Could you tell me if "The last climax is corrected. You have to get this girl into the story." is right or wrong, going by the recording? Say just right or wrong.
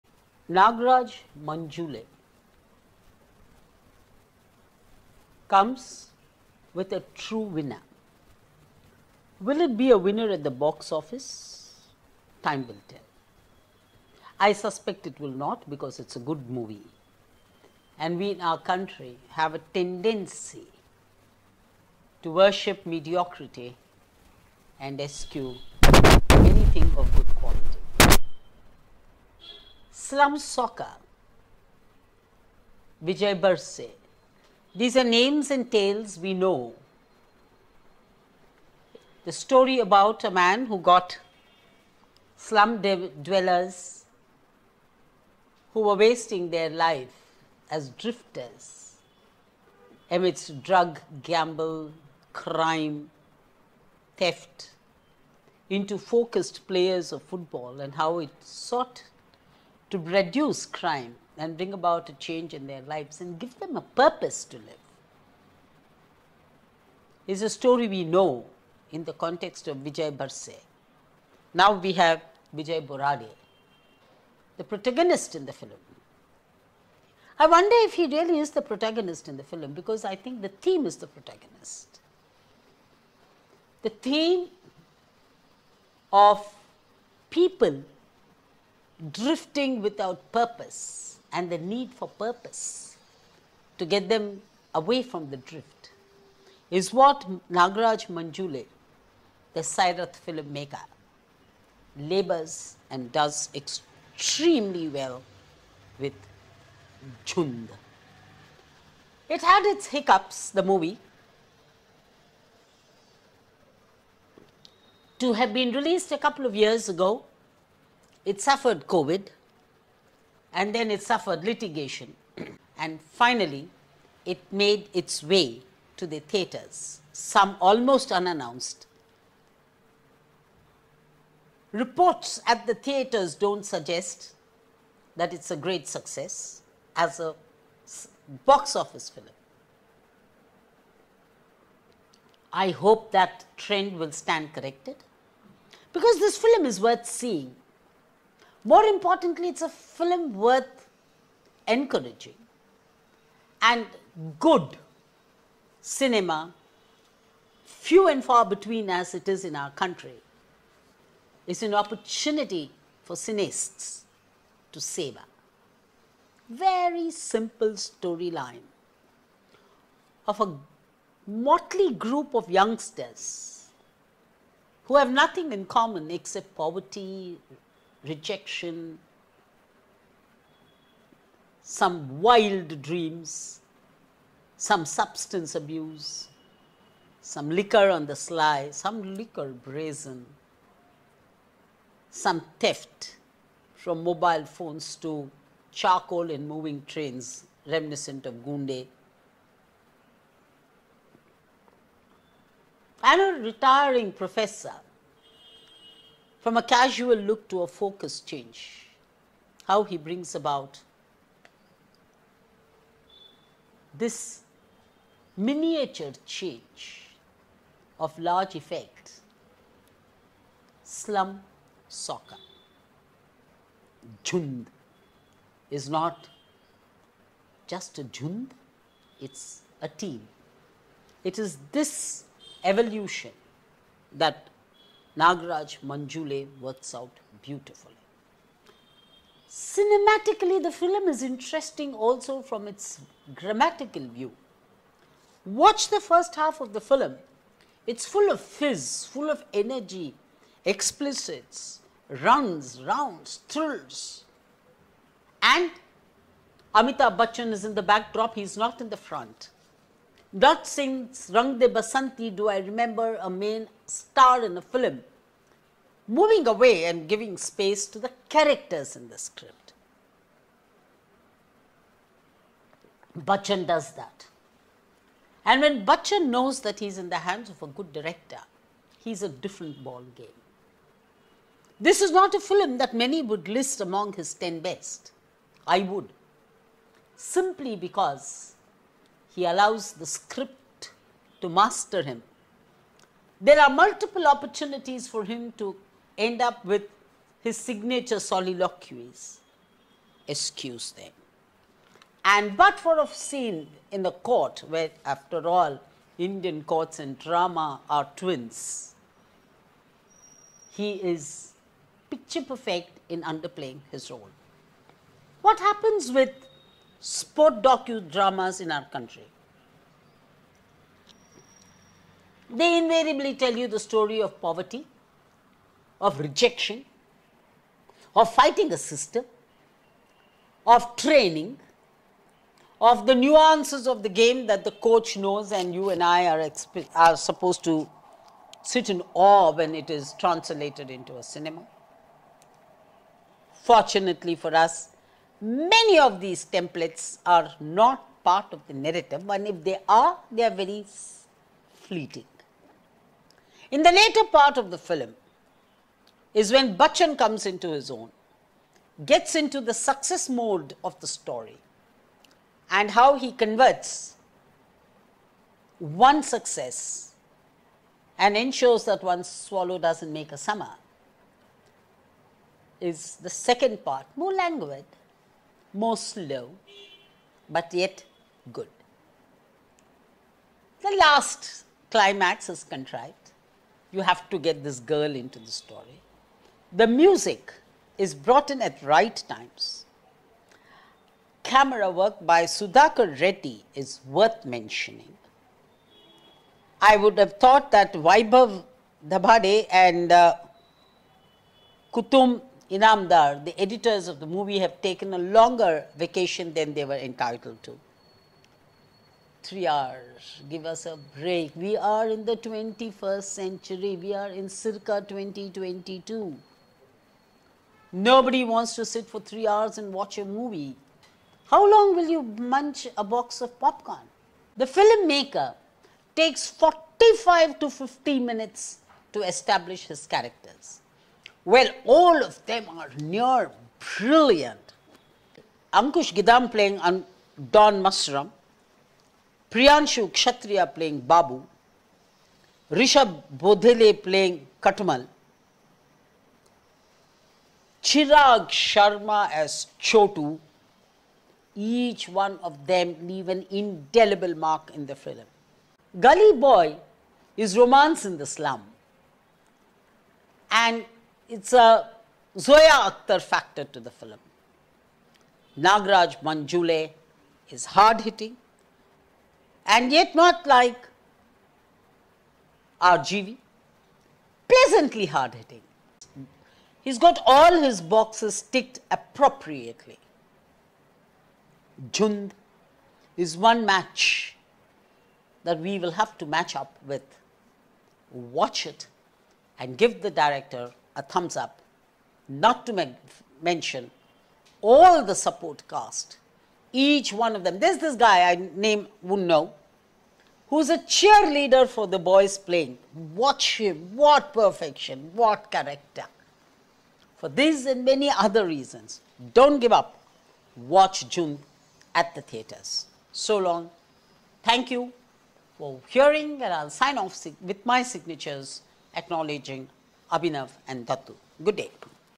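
wrong.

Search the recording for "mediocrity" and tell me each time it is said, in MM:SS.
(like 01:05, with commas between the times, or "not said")
00:22.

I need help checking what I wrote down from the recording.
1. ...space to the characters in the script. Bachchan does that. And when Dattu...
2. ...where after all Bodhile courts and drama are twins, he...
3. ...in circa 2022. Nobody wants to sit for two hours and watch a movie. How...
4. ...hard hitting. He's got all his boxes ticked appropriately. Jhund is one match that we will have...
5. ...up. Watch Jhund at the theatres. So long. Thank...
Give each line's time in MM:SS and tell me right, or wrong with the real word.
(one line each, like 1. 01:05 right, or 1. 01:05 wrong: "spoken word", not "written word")
1. 04:27 wrong: "Bachchan", not "Dattu"
2. 05:04 wrong: "Indian", not "Bodhile"
3. 06:54 wrong: "three", not "two"
4. 07:55 right
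5. 08:29 right.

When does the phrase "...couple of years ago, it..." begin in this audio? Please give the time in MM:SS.
01:56.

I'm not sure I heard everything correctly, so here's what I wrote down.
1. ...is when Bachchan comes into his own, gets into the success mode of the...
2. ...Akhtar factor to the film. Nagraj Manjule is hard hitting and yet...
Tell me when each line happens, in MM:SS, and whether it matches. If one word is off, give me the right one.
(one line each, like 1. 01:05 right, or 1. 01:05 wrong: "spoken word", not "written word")
1. 05:56 right
2. 07:42 right.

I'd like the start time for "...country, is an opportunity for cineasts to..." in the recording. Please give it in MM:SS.
02:39.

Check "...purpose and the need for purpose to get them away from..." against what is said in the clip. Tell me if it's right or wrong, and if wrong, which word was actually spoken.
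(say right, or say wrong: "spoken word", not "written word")
right.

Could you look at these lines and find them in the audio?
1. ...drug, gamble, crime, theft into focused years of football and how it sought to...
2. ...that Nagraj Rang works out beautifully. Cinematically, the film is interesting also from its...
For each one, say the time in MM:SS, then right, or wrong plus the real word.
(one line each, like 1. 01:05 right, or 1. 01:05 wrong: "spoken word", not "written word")
1. 00:50 wrong: "players", not "years"
2. 03:54 wrong: "Manjule", not "Rang".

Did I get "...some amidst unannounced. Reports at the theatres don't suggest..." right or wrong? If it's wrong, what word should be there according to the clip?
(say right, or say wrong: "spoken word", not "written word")
wrong: "almost", not "amidst".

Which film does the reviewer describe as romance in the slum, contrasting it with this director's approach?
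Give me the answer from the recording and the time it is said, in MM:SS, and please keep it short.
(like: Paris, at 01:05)
Gully Boy, at 07:35.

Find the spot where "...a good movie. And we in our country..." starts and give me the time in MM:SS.
00:16.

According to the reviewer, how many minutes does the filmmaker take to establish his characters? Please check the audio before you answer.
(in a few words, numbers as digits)
45 to 50 minutes.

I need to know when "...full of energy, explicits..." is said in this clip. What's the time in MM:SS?
04:09.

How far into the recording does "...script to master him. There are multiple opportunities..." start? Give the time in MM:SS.
04:50.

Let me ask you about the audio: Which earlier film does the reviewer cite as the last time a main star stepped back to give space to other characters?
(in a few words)
Rang De Basanti.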